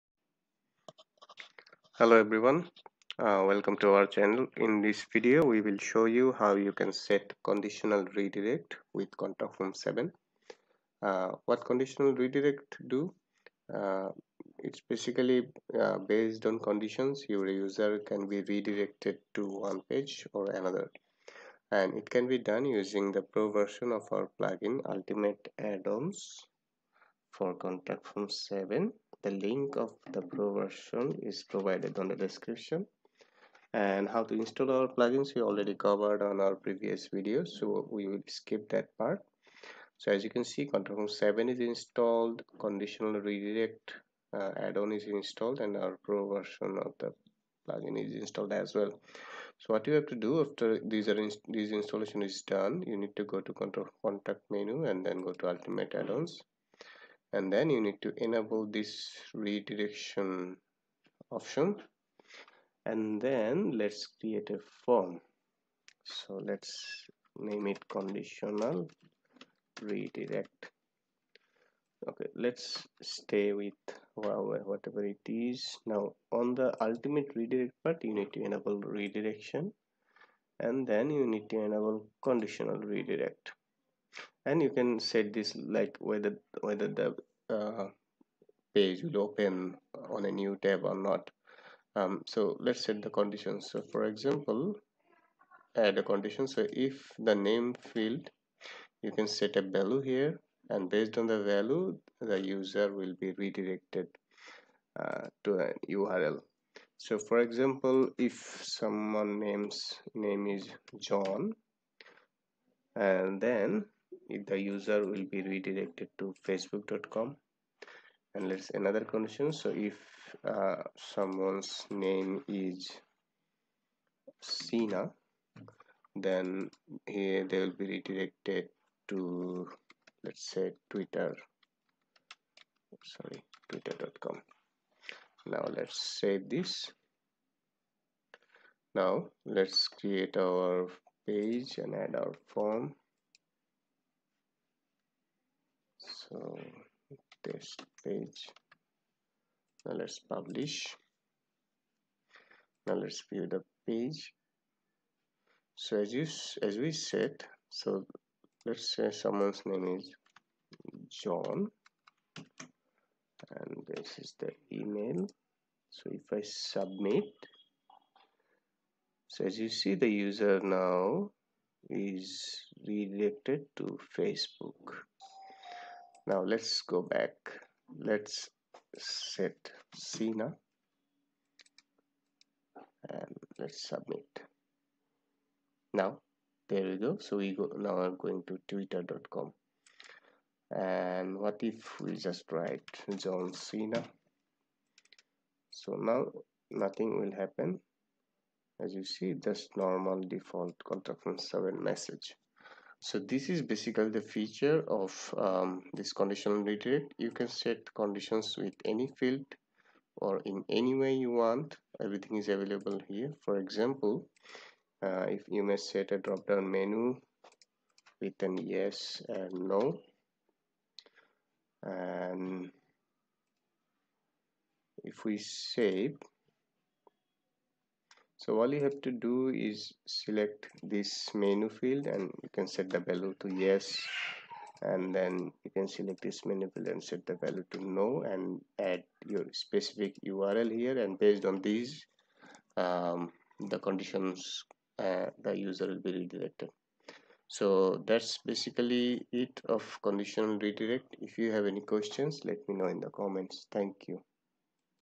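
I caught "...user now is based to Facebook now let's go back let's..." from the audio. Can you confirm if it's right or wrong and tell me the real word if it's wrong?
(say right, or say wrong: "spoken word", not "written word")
wrong: "redirected", not "based".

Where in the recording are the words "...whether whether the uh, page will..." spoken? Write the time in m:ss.
1:25.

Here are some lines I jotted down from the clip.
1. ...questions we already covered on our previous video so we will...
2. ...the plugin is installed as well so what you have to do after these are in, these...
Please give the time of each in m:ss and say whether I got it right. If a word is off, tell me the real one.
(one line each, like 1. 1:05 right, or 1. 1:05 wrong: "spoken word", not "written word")
1. 0:34 wrong: "plugins", not "questions"
2. 0:46 right.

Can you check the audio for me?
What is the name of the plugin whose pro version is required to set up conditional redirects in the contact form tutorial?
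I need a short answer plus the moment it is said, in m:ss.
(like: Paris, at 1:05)
Ultimate Add-ons for Contact Form 7, at 0:24.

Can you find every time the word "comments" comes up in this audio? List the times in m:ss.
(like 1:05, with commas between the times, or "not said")
4:13.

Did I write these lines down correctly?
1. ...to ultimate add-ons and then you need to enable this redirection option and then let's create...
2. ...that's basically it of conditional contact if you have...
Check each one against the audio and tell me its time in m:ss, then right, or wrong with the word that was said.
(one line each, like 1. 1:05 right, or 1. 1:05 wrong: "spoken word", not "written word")
1. 0:55 right
2. 4:08 wrong: "redirect", not "contact".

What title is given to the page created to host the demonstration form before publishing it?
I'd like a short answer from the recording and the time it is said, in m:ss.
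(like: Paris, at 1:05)
Test page, at 2:27.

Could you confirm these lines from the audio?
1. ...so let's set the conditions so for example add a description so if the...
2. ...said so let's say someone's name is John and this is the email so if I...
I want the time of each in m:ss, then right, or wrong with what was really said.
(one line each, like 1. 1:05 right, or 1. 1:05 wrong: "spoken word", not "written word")
1. 1:32 wrong: "condition", not "description"
2. 2:36 right.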